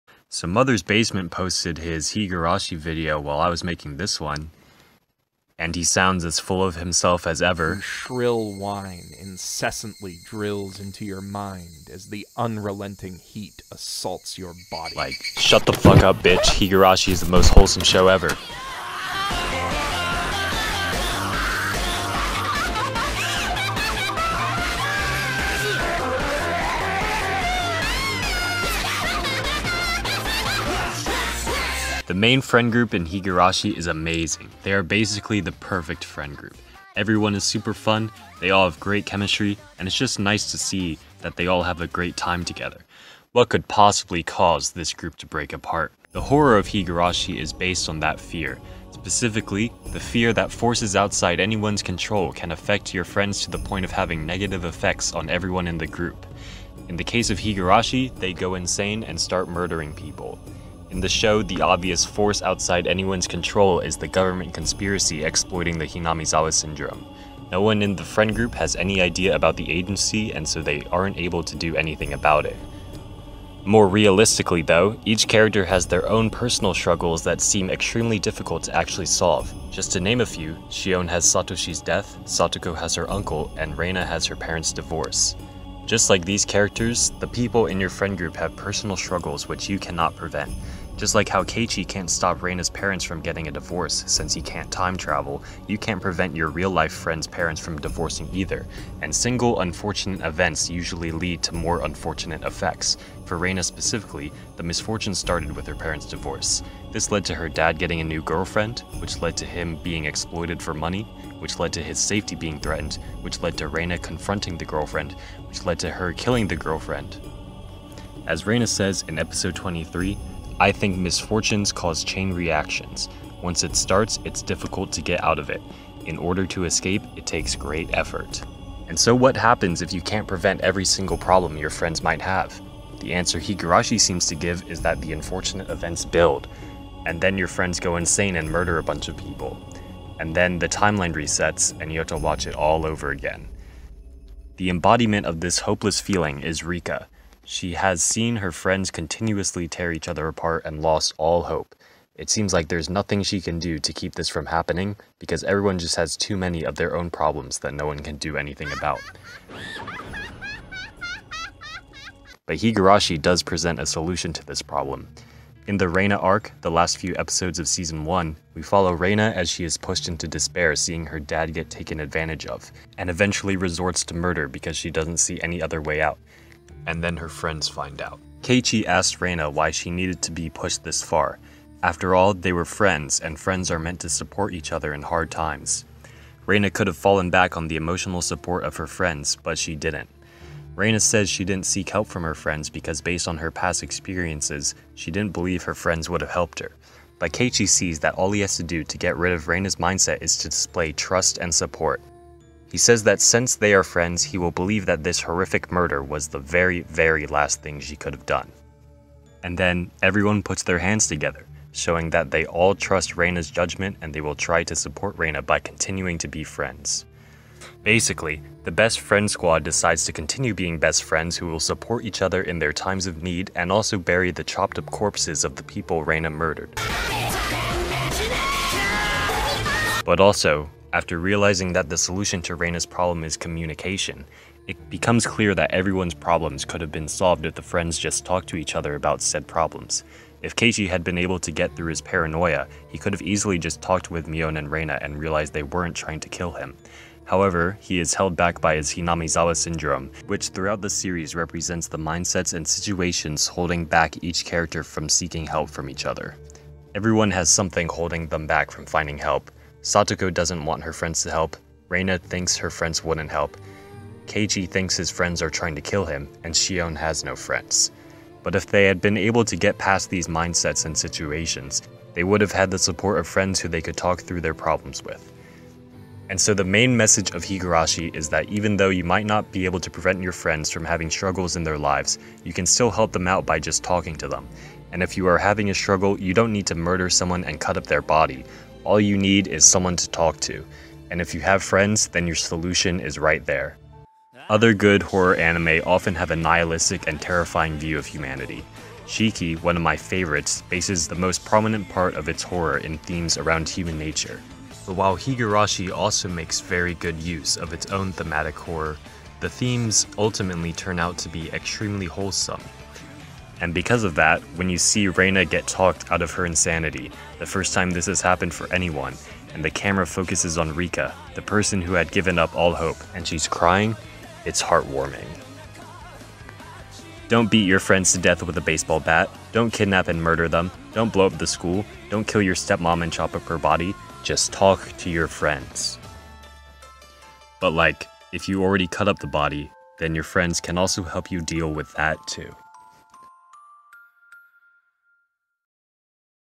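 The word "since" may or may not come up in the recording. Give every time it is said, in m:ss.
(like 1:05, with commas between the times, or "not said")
1:34, 3:23.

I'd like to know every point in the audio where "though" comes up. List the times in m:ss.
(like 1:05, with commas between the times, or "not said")
1:14, 4:38.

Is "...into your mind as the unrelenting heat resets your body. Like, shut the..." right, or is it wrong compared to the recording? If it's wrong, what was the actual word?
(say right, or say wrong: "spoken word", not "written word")
wrong: "assaults", not "resets".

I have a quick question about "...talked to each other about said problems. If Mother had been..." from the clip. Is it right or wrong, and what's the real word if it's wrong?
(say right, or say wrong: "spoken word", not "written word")
wrong: "Keiichi", not "Mother".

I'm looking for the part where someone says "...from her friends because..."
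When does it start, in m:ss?
3:12.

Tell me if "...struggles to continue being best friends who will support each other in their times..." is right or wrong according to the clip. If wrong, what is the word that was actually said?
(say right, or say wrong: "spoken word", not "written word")
wrong: "decides", not "struggles".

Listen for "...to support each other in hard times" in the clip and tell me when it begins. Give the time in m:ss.
3:04.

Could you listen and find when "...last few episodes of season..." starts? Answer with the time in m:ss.
2:46.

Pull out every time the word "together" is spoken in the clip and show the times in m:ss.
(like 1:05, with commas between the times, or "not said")
0:42, 3:31.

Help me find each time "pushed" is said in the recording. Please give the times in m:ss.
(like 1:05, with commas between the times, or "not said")
2:49, 3:00.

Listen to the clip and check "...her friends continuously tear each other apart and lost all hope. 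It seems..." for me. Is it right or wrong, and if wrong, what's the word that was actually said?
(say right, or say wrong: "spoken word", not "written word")
right.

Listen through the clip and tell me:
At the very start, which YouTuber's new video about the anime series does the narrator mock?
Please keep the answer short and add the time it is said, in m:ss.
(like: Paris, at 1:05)
Mother's Basement, at 0:00.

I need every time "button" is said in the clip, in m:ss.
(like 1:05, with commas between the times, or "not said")
not said.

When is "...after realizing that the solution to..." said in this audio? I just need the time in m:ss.
3:50.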